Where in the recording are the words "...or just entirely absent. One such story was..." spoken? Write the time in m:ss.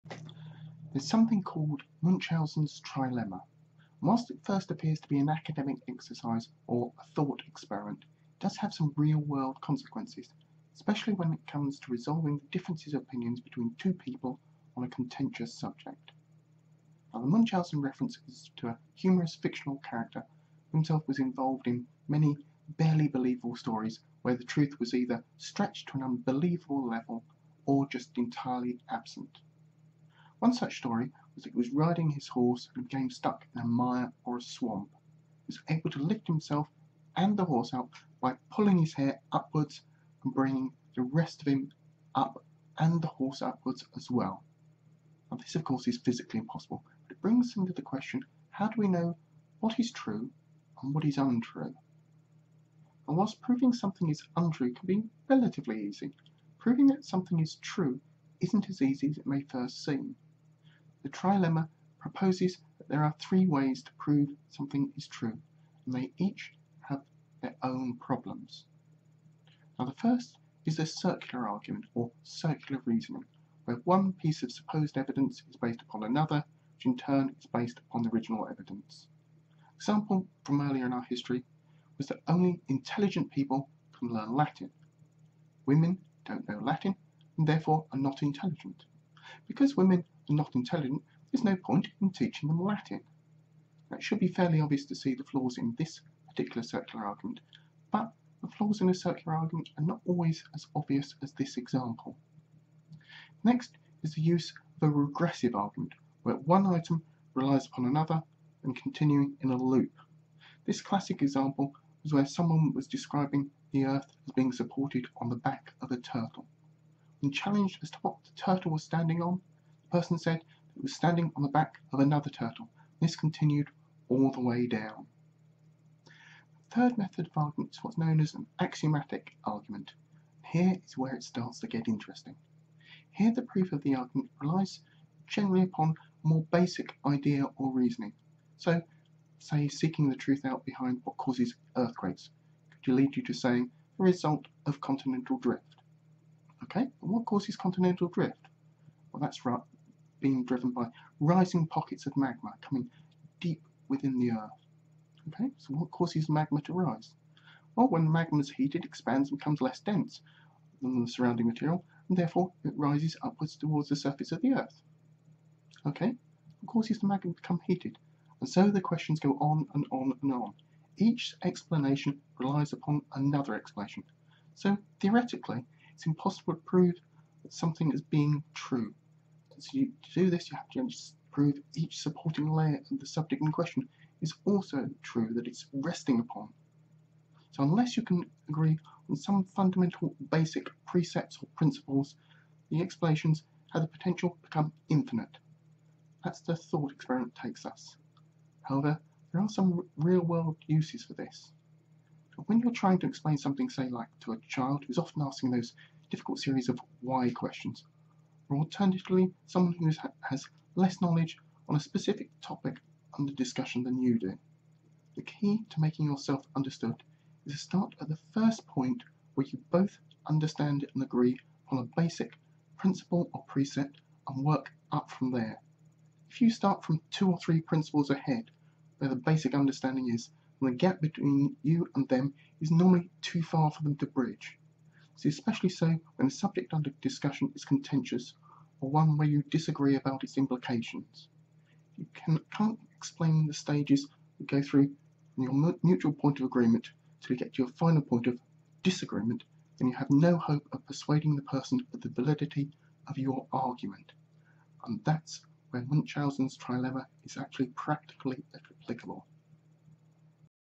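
0:27.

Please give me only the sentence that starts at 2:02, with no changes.
This continued all the way down.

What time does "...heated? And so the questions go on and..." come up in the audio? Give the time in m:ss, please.
2:47.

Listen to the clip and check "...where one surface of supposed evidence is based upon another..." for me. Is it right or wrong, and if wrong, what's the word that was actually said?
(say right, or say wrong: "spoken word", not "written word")
wrong: "piece", not "surface".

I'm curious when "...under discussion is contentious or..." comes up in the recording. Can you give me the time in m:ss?
3:56.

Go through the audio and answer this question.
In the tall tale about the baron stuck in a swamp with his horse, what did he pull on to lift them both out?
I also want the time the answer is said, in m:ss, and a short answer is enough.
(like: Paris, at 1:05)
His hair, at 0:38.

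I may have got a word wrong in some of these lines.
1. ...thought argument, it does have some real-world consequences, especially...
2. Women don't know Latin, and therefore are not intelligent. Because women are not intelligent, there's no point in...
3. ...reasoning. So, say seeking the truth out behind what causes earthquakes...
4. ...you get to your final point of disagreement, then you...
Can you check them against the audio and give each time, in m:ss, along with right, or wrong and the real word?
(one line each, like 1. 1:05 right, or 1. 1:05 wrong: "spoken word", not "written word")
1. 0:07 wrong: "experiment", not "argument"
2. 1:25 right
3. 2:17 right
4. 4:07 right.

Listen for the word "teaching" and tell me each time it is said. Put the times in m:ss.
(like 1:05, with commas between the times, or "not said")
1:32.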